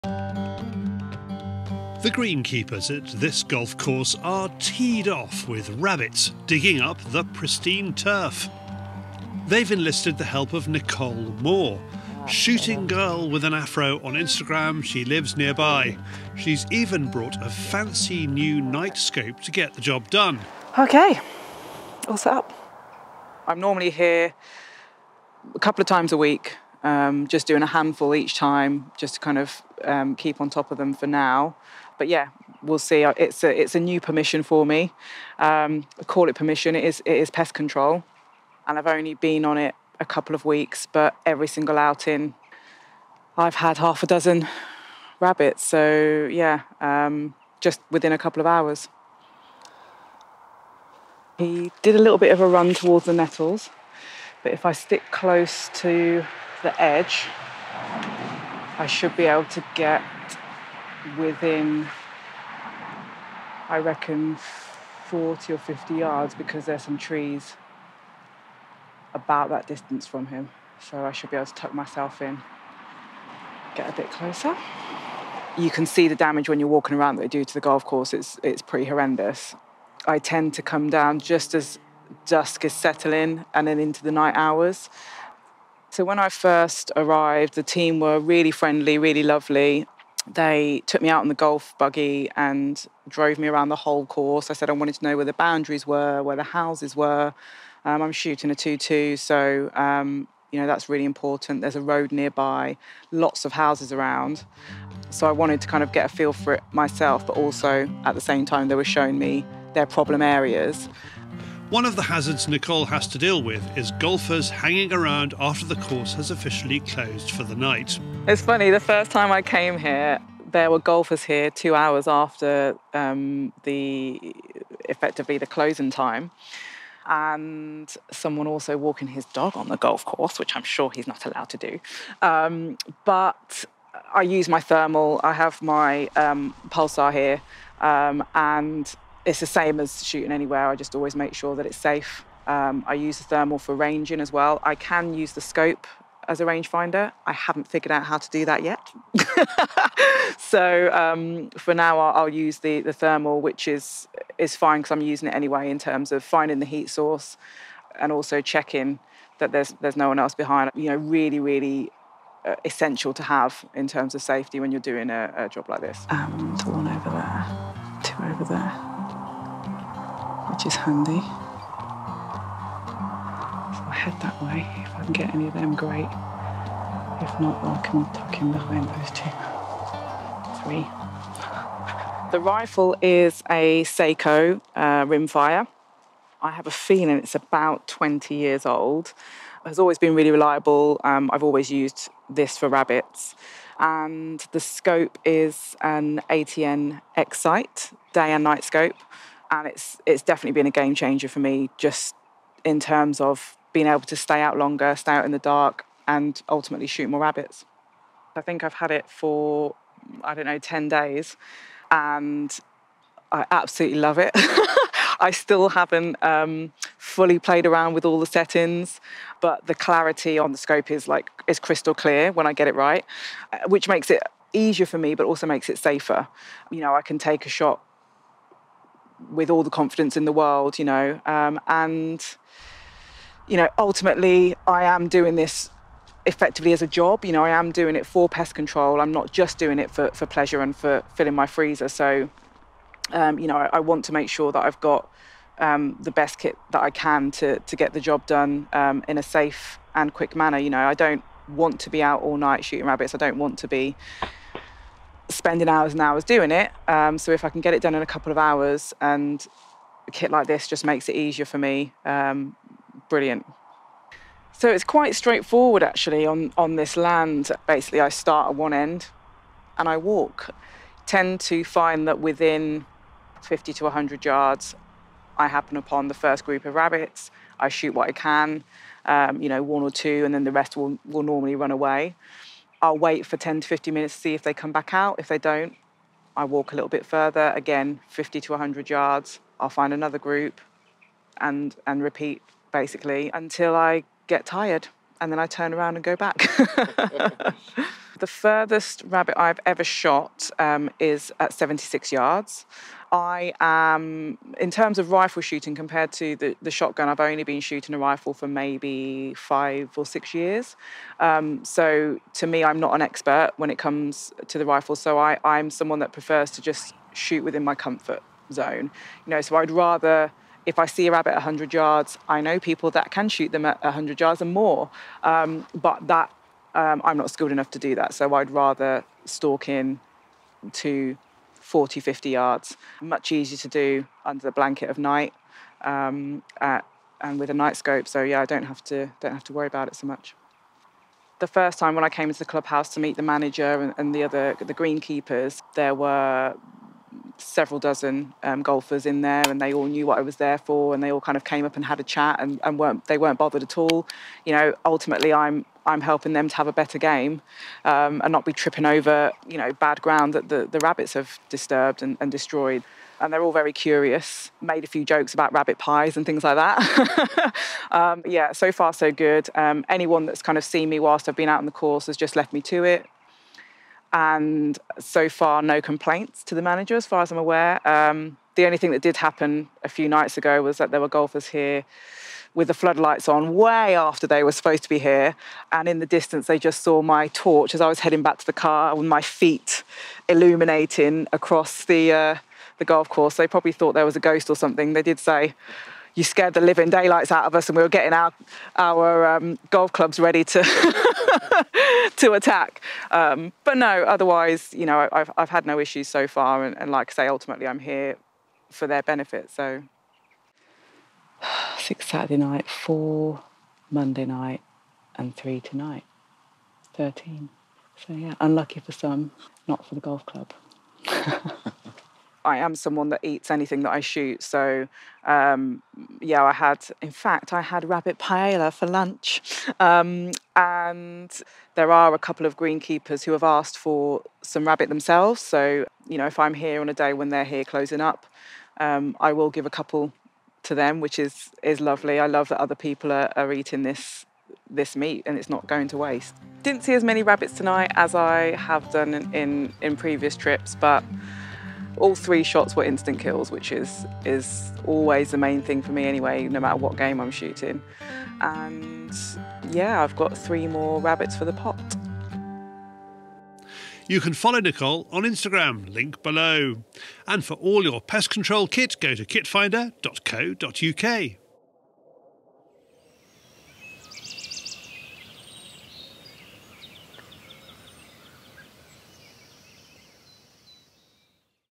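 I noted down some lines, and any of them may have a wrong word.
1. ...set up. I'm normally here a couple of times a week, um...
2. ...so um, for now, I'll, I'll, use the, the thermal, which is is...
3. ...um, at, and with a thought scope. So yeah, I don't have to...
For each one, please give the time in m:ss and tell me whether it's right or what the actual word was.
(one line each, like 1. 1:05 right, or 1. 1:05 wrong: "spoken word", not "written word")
1. 0:22 right
2. 2:30 right
3. 5:35 wrong: "night", not "thought".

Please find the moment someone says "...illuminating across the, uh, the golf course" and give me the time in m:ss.
6:30.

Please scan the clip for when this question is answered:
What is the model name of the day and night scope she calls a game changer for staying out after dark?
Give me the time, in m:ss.
3:16.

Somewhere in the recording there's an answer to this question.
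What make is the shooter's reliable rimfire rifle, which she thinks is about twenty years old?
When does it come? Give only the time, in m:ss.
3:03.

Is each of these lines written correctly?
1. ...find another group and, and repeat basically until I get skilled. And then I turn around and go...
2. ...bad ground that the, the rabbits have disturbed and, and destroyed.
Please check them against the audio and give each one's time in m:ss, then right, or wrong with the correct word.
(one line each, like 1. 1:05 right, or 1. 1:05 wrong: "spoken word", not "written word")
1. 4:49 wrong: "tired", not "skilled"
2. 5:59 right.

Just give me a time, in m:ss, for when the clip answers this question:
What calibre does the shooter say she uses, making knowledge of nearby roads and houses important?
1:38.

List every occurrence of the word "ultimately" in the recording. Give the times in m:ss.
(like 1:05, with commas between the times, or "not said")
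3:26, 3:53, 5:54, 6:47.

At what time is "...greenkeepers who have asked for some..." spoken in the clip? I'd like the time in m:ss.
7:12.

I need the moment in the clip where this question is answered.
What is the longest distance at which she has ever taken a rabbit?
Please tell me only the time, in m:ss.
5:01.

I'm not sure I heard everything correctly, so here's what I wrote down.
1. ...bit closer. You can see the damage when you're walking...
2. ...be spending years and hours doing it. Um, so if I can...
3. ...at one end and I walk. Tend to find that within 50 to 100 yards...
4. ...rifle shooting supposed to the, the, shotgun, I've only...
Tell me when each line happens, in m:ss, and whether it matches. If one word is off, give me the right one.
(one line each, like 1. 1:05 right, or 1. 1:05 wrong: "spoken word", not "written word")
1. 1:13 right
2. 4:13 wrong: "hours", not "years"
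3. 4:28 right
4. 5:05 wrong: "compared", not "supposed".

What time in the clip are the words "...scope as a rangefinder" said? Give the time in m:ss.
2:25.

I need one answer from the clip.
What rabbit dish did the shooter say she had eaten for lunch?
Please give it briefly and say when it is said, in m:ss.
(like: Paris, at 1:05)
rabbit paella, at 7:07.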